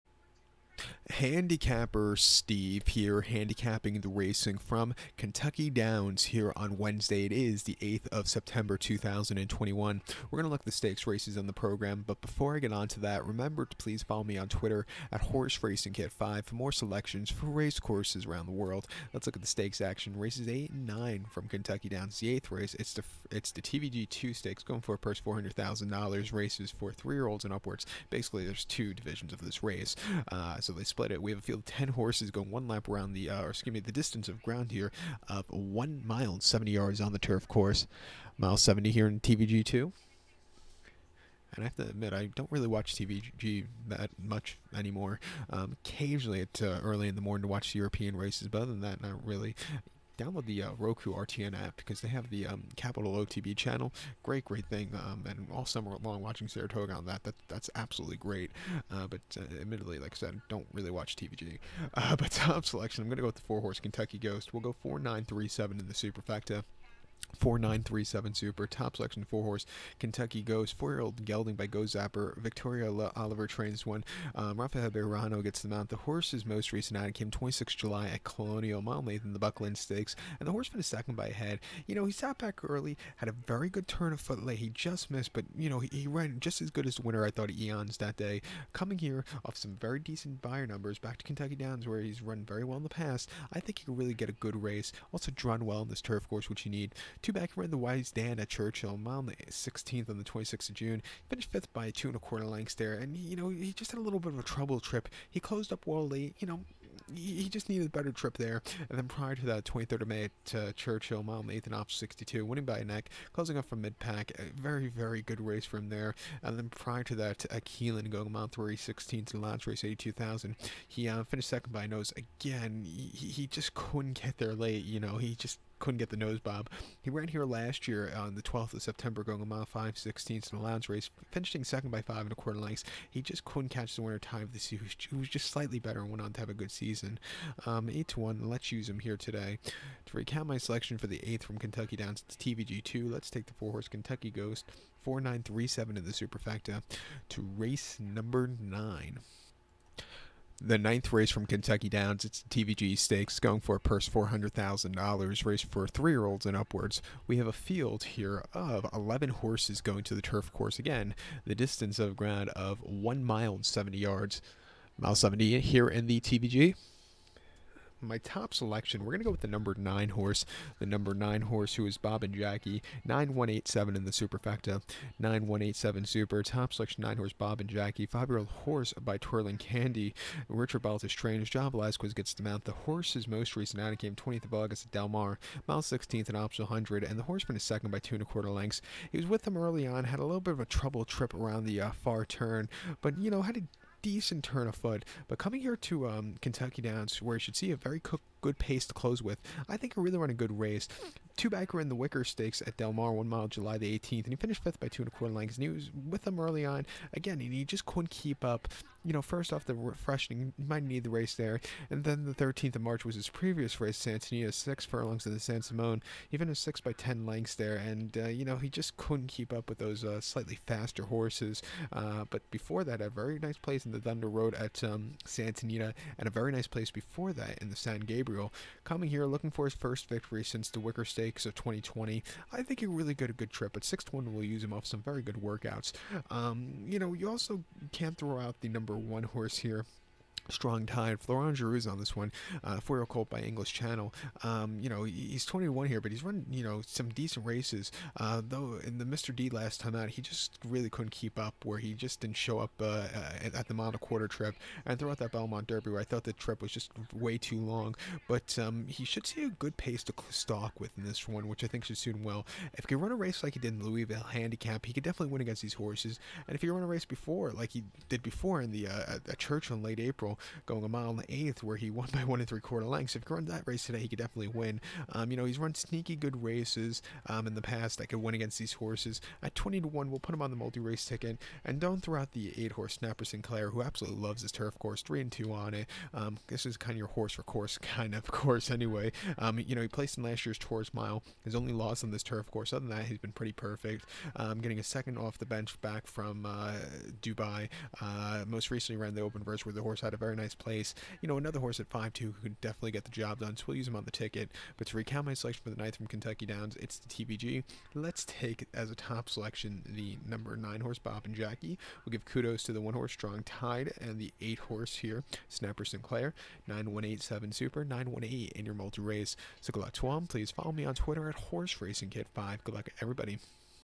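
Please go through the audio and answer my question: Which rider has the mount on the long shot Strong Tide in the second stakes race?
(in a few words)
Florent Geroux.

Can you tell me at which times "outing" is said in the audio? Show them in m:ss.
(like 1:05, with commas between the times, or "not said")
1:16, 3:03.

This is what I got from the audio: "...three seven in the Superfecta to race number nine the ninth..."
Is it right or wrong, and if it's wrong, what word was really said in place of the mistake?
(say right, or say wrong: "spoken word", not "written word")
right.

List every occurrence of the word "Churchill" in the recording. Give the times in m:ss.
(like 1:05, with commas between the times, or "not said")
1:38, 1:50.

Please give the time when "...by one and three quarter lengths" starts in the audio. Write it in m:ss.
4:32.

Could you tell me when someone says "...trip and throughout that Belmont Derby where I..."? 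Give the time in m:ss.
4:14.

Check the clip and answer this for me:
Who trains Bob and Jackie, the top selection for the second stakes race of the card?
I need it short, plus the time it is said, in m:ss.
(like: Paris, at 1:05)
Richard Baltas, at 3:00.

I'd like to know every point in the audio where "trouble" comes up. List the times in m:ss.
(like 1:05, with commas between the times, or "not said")
1:44, 3:10.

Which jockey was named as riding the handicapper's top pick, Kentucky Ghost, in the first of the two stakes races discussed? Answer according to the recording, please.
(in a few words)
Rafael Bejarano.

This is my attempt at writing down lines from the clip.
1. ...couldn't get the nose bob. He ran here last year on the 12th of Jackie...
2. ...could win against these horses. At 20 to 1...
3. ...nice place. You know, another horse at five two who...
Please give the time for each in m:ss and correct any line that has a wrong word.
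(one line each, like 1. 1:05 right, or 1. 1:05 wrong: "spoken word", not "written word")
1. 2:05 wrong: "September", not "Jackie"
2. 4:38 right
3. 5:00 right.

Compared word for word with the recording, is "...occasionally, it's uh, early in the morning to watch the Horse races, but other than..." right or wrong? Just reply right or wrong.
wrong.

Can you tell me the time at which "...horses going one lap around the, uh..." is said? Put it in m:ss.
0:31.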